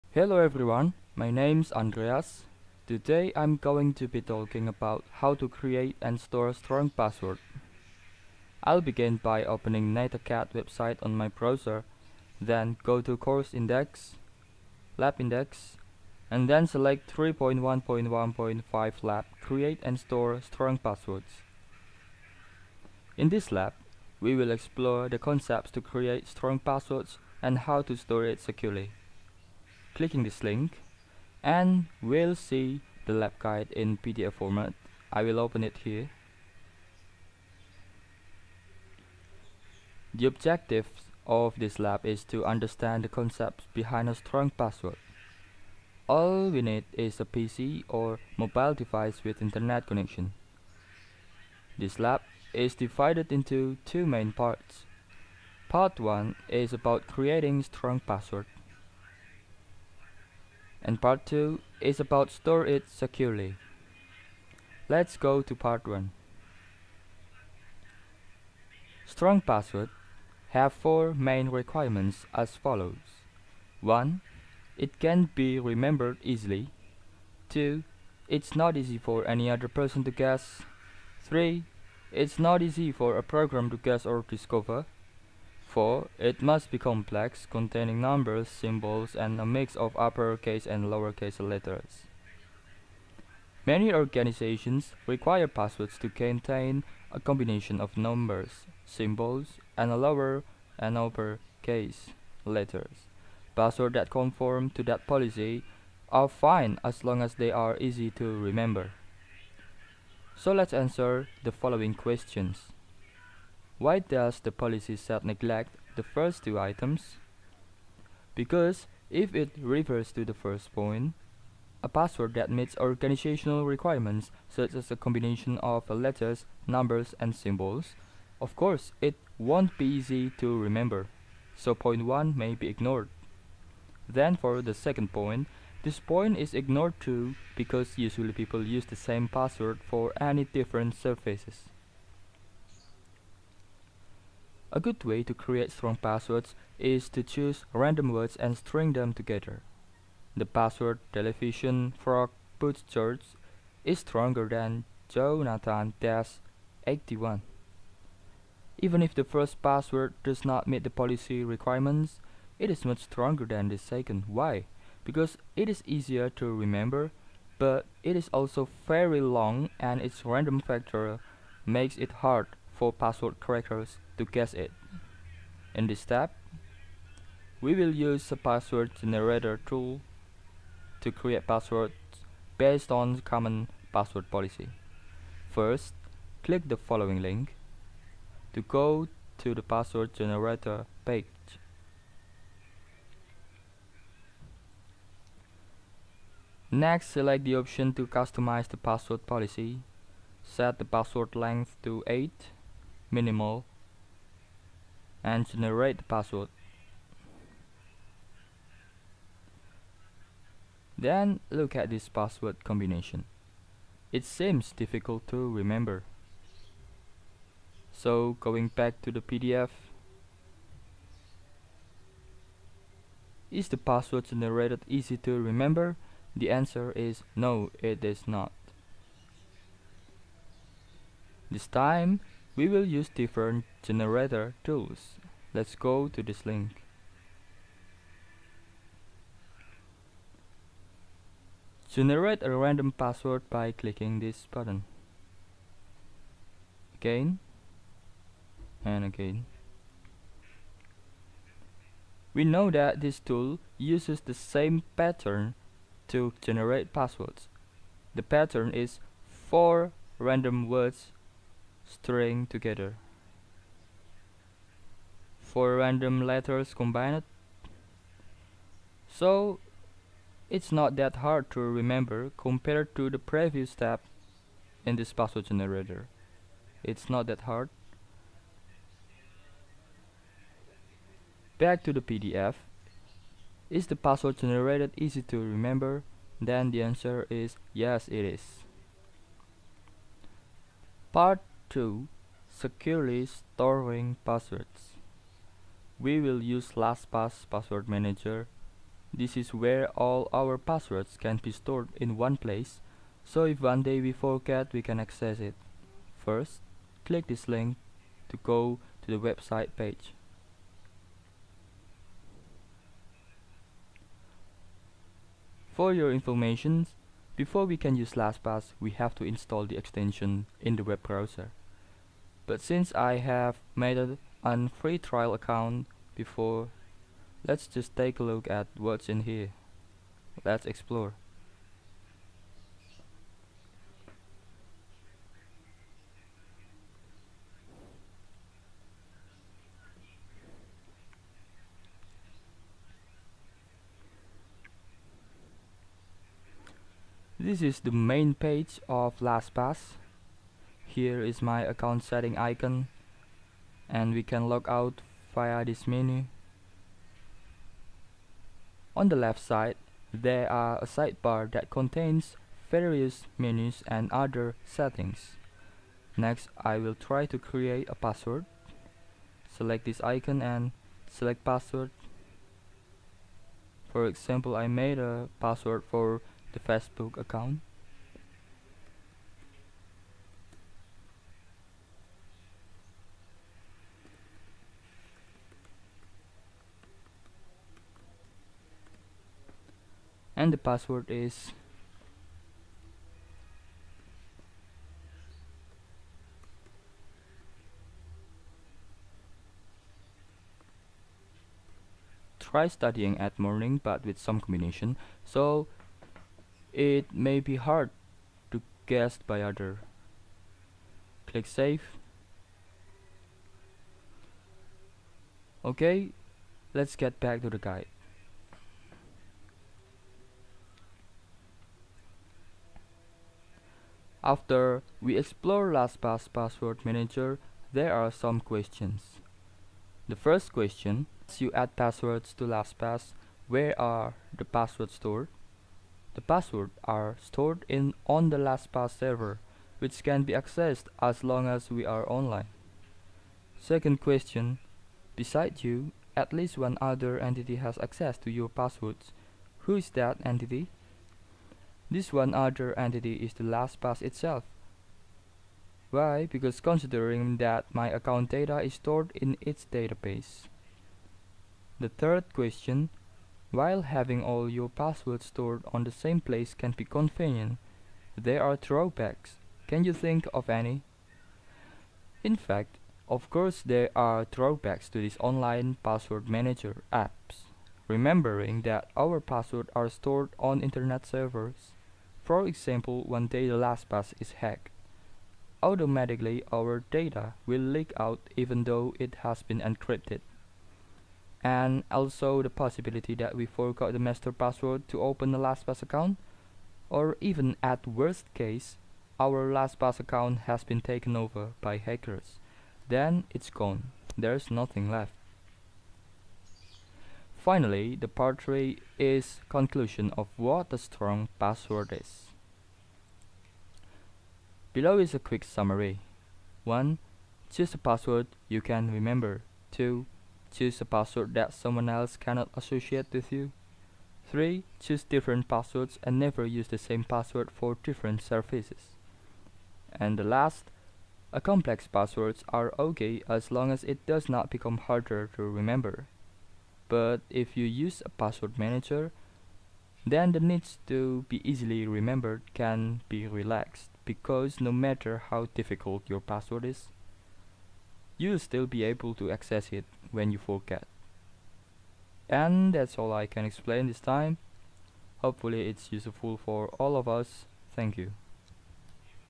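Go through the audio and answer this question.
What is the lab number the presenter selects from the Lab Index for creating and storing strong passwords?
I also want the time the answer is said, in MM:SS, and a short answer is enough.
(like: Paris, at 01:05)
3.1.1.5, at 00:17.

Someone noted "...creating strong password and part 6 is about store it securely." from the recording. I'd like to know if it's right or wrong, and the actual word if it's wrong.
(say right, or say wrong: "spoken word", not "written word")
wrong: "2", not "6".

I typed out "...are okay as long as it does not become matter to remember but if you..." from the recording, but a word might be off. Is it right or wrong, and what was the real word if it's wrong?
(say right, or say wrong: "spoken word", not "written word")
wrong: "harder", not "matter".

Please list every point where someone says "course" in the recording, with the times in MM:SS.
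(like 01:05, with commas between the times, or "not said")
00:13, 02:08, 07:53.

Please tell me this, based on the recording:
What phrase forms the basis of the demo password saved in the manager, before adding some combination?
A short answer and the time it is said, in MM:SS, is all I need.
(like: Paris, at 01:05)
try studying at morning, at 06:42.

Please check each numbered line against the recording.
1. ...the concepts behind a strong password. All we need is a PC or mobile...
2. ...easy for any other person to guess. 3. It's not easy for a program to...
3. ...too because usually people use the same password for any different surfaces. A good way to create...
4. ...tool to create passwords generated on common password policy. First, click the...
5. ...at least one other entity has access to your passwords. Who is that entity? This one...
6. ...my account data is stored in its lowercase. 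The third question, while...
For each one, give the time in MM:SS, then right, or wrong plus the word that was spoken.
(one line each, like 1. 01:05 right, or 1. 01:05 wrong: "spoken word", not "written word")
1. 00:43 right
2. 01:18 right
3. 02:16 right
4. 02:59 wrong: "based", not "generated"
5. 07:26 right
6. 07:37 wrong: "database", not "lowercase".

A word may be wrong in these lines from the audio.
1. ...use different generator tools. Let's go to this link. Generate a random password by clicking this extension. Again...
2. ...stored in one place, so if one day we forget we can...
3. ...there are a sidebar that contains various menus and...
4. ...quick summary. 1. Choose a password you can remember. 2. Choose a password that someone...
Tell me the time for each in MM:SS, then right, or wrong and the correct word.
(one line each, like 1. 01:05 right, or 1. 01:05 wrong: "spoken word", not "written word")
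1. 03:52 wrong: "button", not "extension"
2. 05:01 right
3. 06:00 right
4. 08:35 right.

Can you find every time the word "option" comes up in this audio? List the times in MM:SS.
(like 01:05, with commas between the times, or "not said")
03:17.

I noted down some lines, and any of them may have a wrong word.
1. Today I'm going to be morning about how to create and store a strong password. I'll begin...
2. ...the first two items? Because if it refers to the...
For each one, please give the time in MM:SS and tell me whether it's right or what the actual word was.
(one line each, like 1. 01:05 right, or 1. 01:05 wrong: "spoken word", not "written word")
1. 00:02 wrong: "talking", not "morning"
2. 01:55 right.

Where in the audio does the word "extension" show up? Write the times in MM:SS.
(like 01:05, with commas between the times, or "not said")
05:19.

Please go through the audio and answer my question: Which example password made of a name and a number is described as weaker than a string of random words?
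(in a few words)
Jonathan-81.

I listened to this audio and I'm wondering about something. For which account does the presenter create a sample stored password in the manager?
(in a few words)
Facebook.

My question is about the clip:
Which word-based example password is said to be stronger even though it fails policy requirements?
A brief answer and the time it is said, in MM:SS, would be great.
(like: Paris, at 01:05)
television frog boot church, at 02:31.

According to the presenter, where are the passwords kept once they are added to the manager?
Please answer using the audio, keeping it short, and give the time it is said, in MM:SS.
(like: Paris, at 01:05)
LastPass server, at 07:18.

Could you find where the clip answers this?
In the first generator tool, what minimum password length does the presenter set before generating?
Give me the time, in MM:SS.
03:22.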